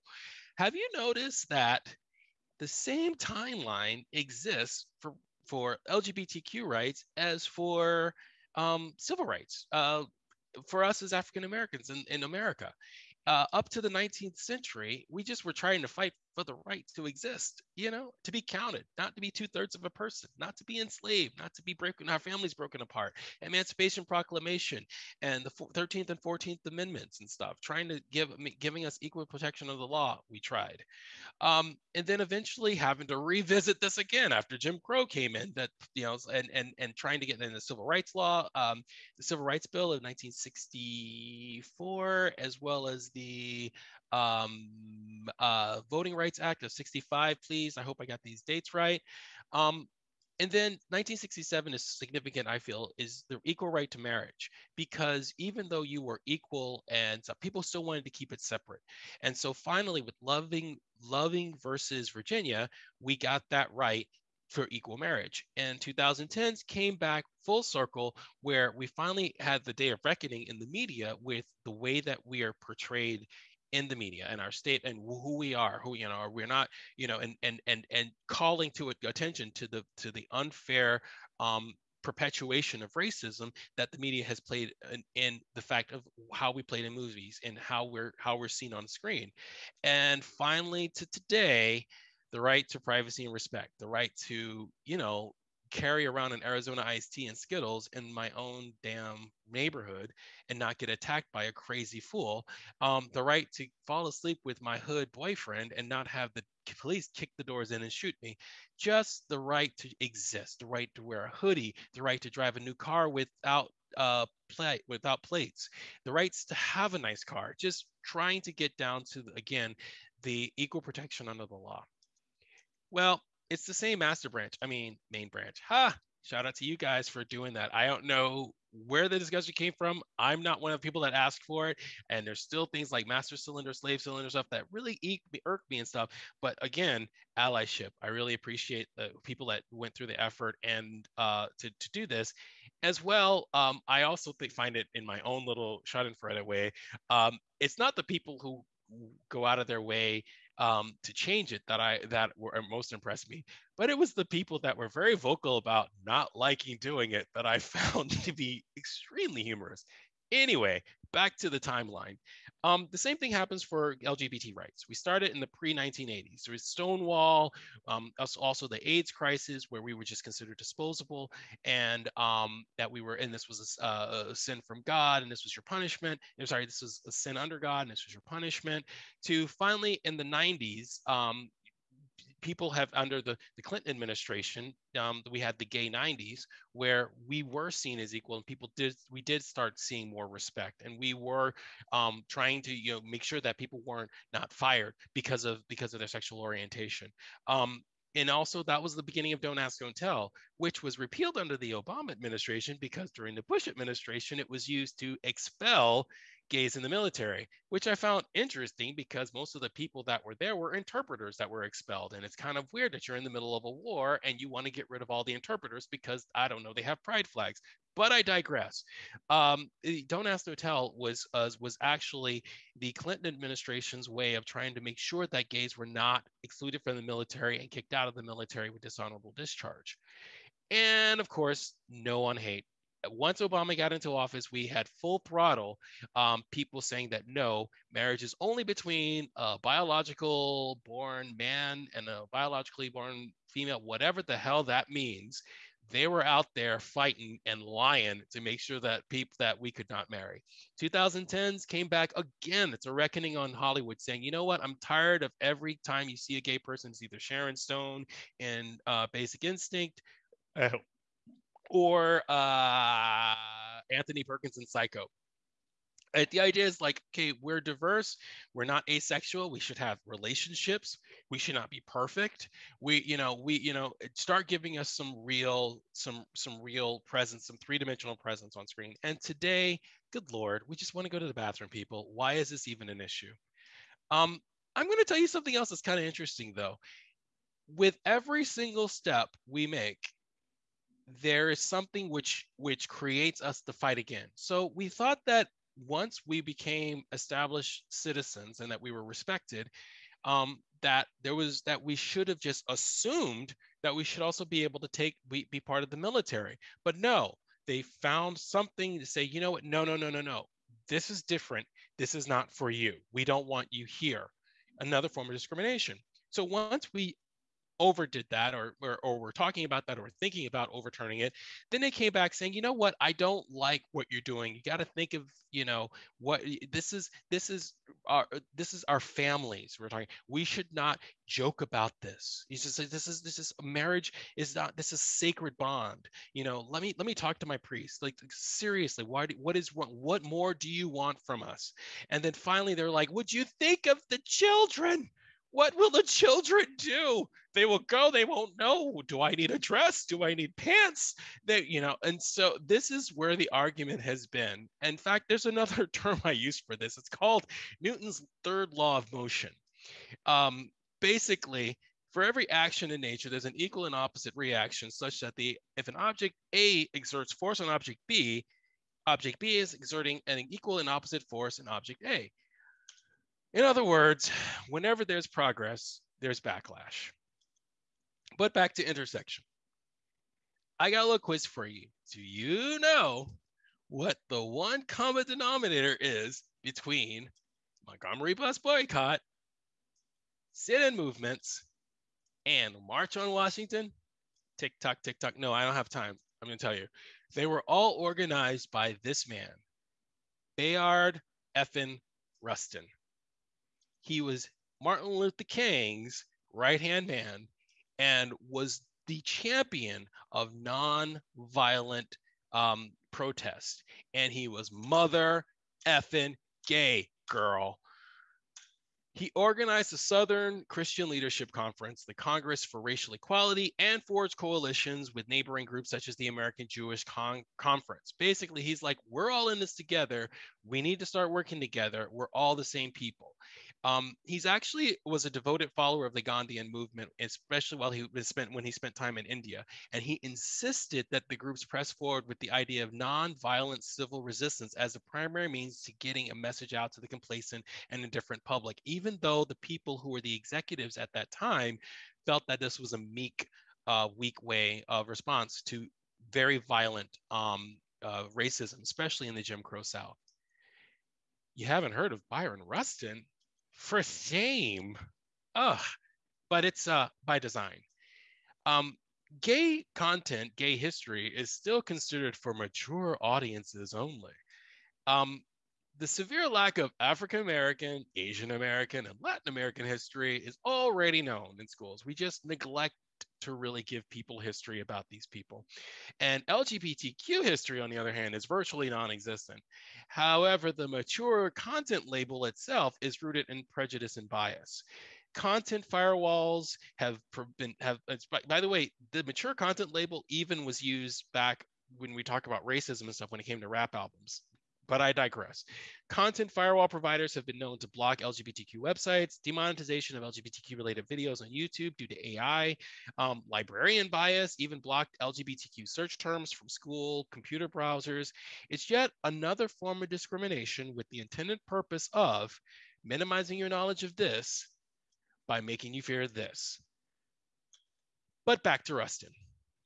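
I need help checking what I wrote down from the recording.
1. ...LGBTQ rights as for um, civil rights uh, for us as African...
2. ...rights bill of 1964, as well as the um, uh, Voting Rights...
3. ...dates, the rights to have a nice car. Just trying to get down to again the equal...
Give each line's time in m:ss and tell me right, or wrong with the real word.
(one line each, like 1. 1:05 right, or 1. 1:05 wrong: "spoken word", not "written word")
1. 0:05 right
2. 0:39 right
3. 1:55 wrong: "plates", not "dates".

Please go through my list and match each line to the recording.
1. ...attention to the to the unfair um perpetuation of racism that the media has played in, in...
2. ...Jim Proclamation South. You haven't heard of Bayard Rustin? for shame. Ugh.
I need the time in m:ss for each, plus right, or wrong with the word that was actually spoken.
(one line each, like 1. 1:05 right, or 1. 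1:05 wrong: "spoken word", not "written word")
1. 1:19 right
2. 7:39 wrong: "Crow", not "Proclamation".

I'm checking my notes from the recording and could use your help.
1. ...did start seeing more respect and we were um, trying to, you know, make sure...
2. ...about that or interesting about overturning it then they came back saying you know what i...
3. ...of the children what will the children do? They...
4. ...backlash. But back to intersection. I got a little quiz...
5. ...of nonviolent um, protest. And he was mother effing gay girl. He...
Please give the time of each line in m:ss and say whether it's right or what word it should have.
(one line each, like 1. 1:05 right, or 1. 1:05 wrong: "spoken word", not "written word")
1. 3:09 right
2. 5:19 wrong: "thinking", not "interesting"
3. 5:43 right
4. 6:16 right
5. 6:50 right.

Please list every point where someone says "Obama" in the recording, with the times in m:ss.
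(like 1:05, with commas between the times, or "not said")
3:21, 3:53.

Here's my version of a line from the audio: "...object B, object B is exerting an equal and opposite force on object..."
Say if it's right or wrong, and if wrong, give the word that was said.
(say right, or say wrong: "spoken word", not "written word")
right.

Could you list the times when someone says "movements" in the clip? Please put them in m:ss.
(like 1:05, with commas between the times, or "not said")
6:30, 7:16.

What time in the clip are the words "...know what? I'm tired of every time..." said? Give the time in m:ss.
4:14.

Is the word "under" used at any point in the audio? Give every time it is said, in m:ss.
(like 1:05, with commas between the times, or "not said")
2:01, 2:57, 3:02, 3:21.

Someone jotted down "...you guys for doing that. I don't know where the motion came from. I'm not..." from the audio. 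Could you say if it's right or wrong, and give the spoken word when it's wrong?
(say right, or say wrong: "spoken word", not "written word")
wrong: "discussion", not "motion".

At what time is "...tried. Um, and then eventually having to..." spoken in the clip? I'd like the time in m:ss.
0:30.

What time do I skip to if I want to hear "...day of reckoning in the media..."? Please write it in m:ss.
1:09.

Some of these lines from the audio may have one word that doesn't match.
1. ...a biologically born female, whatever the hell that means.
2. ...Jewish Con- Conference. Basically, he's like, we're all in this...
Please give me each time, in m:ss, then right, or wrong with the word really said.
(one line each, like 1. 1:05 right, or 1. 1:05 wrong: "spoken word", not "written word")
1. 4:02 right
2. 7:06 right.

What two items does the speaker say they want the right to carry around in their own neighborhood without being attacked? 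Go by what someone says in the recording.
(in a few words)
Arizona iced tea and Skittles.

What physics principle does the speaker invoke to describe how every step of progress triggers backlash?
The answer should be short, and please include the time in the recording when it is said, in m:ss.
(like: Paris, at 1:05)
Newton's third law of motion, at 5:57.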